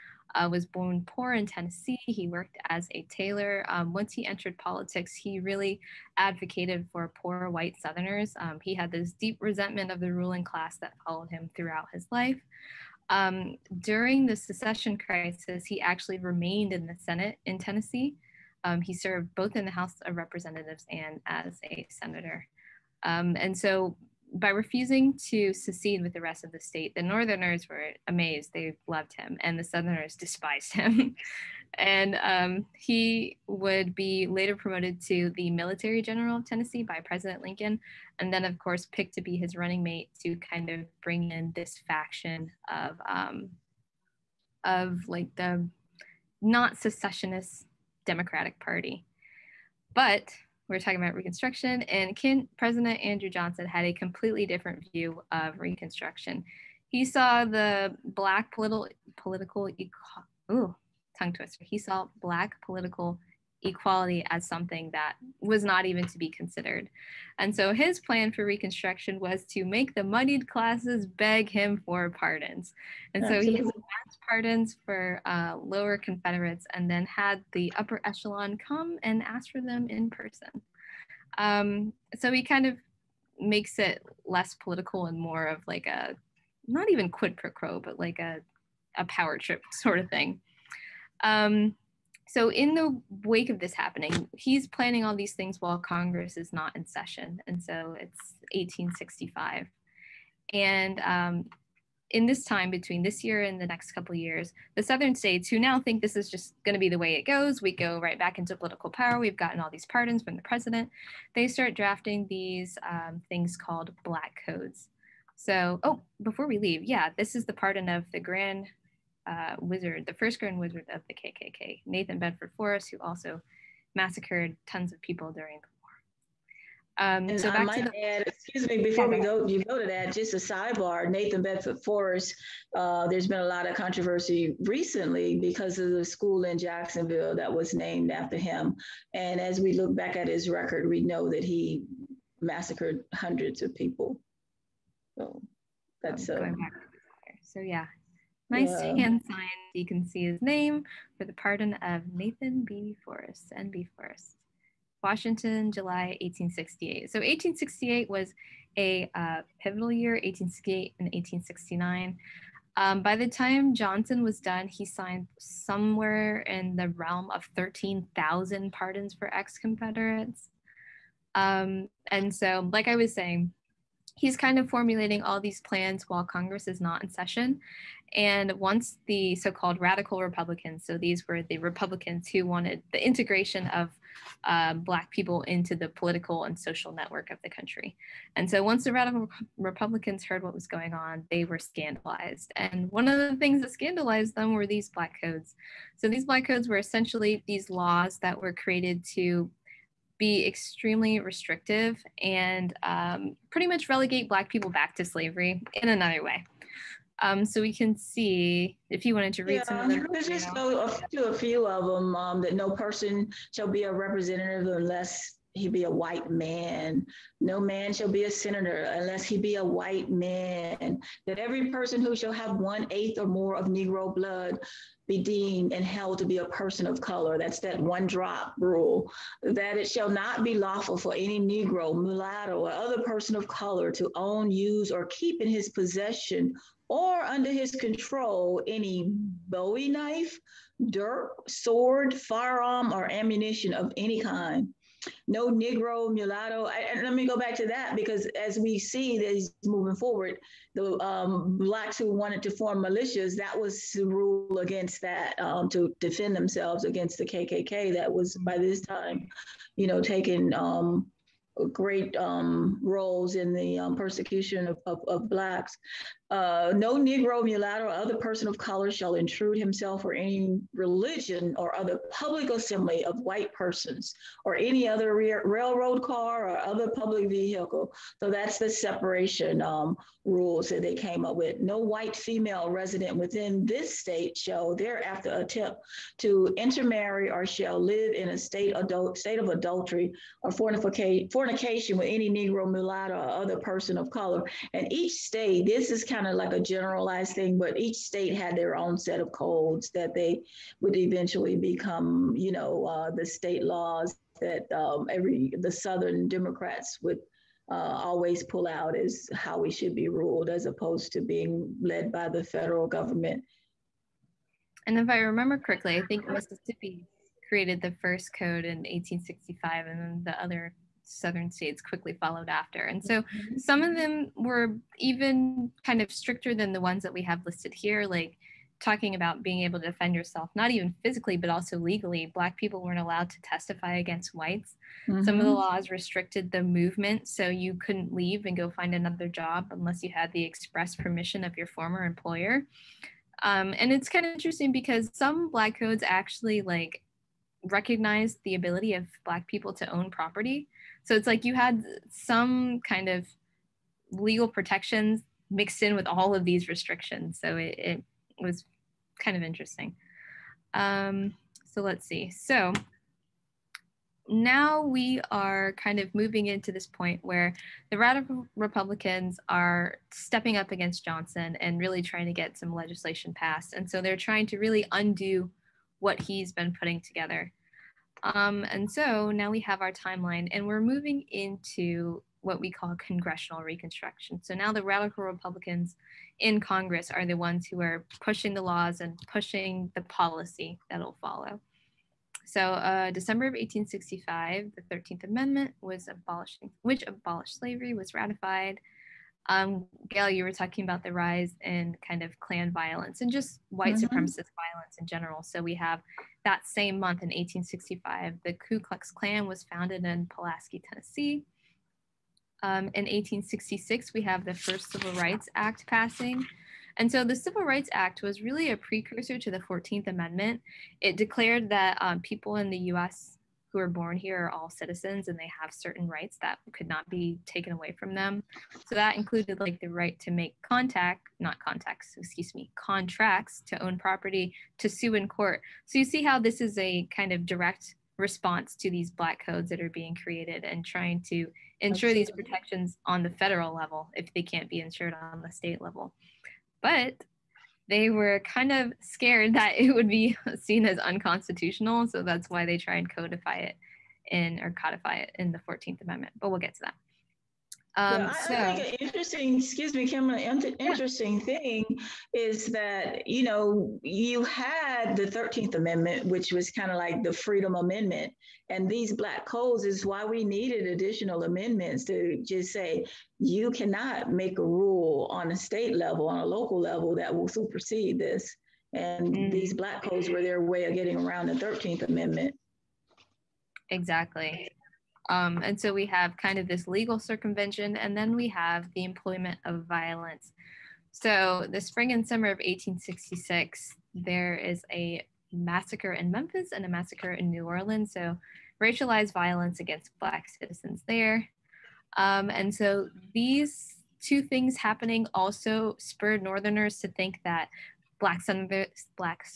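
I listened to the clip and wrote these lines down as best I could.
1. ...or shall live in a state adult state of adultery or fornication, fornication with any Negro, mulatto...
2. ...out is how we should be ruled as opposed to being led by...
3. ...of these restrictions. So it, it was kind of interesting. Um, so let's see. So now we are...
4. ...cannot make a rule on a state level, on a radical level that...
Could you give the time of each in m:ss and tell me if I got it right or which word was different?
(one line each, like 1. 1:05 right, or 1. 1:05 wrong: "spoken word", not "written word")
1. 4:47 right
2. 5:08 right
3. 5:56 right
4. 7:53 wrong: "local", not "radical".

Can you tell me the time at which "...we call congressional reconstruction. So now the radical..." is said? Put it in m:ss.
6:22.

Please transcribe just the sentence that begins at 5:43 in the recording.
Um, and it's kind of interesting because some Black codes actually like recognize the ability of Black people to own property.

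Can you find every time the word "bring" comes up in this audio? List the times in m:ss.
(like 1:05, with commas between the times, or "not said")
0:41.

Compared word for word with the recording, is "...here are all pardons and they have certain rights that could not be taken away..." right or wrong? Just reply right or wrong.
wrong.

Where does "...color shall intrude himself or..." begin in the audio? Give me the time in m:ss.
4:28.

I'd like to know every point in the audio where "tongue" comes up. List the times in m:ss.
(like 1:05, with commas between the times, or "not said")
1:01.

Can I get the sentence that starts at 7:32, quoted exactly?
So that's why they try and codify it in or codify it in the 14th Amendment.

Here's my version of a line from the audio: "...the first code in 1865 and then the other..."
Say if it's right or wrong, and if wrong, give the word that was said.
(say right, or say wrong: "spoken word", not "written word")
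right.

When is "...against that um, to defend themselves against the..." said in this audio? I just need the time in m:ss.
4:14.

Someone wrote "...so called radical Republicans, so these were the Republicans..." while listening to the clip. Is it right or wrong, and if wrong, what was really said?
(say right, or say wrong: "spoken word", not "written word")
right.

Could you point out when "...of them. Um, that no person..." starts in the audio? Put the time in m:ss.
3:31.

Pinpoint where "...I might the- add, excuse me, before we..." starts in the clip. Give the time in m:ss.
2:07.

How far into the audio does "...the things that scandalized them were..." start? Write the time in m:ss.
3:13.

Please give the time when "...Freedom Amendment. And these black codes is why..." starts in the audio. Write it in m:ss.
7:47.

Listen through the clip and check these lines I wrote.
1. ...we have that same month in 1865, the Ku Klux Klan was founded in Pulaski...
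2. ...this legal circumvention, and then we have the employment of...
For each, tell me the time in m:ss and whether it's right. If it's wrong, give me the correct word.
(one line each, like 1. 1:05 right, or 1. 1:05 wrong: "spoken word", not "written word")
1. 6:45 right
2. 8:06 right.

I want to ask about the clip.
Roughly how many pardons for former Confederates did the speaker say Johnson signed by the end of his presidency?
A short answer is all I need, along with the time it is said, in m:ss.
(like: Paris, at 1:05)
13,000, at 2:47.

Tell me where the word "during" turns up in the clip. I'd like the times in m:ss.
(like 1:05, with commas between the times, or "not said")
0:13, 2:05.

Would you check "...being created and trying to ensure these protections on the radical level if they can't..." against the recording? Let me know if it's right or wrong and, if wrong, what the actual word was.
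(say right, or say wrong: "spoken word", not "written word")
wrong: "federal", not "radical".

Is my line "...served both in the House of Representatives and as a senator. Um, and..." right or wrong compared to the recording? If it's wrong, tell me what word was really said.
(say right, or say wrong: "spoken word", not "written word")
right.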